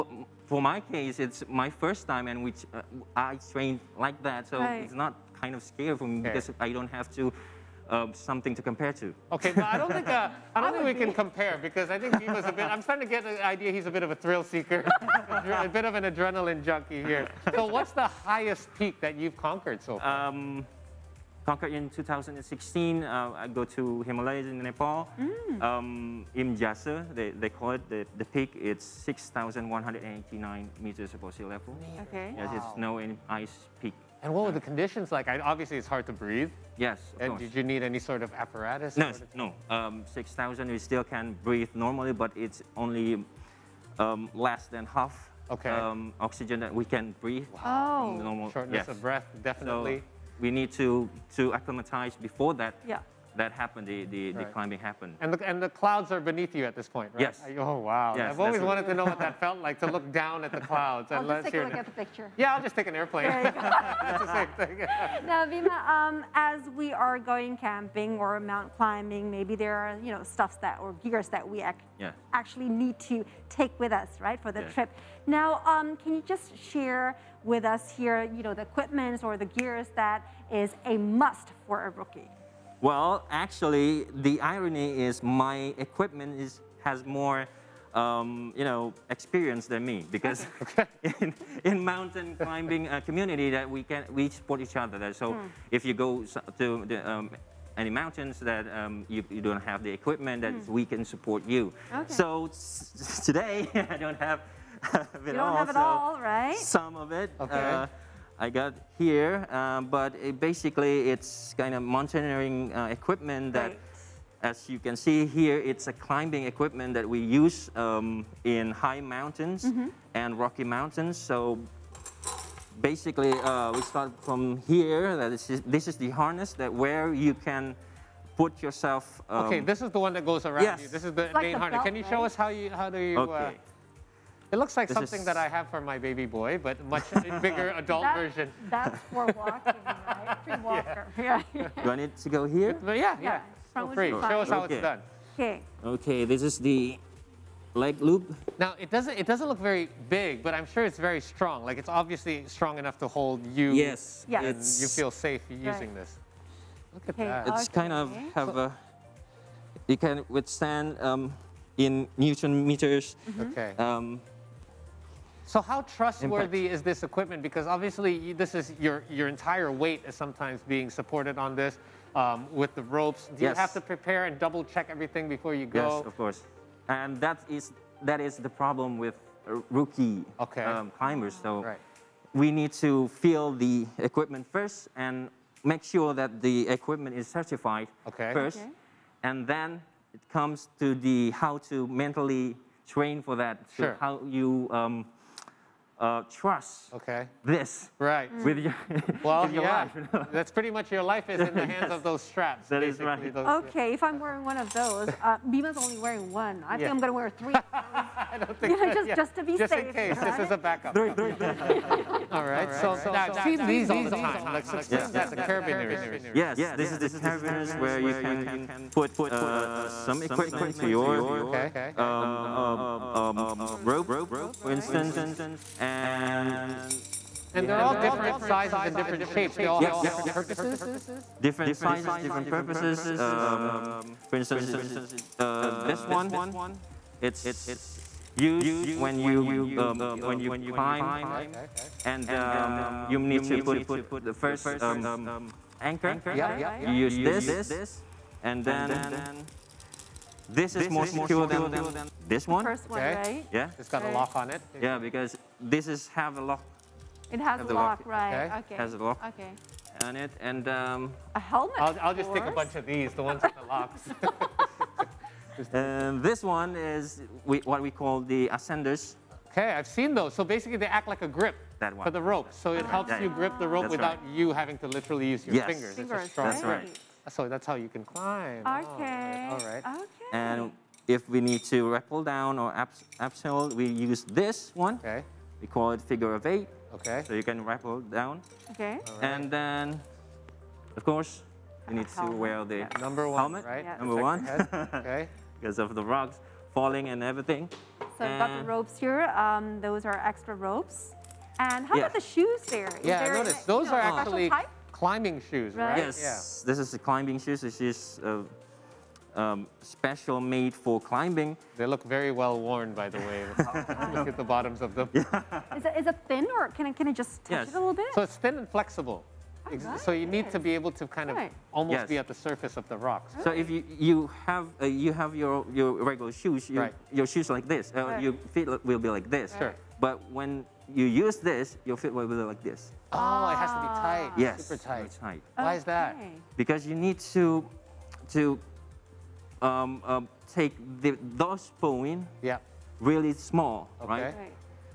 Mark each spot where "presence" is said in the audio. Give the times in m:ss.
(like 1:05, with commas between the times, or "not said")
not said.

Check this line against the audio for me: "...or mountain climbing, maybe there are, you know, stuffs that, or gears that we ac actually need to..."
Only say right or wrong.
right.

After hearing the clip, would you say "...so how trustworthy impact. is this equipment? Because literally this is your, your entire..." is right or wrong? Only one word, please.
wrong.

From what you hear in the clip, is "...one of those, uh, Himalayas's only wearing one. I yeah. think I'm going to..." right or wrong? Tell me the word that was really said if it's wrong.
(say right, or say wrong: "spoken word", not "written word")
wrong: "Bima", not "Himalayas".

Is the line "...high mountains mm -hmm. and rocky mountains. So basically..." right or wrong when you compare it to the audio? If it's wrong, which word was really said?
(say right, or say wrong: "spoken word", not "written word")
right.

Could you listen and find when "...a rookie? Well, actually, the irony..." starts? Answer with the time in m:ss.
1:21.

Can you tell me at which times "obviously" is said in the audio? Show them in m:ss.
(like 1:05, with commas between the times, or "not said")
0:35, 2:31, 2:47.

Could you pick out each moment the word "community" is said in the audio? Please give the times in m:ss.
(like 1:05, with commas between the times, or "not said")
1:33.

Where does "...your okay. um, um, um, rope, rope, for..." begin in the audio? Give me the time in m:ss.
3:40.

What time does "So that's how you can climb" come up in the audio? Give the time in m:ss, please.
4:37.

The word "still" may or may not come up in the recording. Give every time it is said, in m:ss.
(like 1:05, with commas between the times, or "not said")
0:40.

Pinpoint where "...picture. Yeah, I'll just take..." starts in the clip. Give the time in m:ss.
1:01.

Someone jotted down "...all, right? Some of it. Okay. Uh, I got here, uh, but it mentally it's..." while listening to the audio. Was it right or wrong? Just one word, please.
wrong.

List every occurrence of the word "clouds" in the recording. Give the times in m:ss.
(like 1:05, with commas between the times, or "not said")
0:55, 1:00.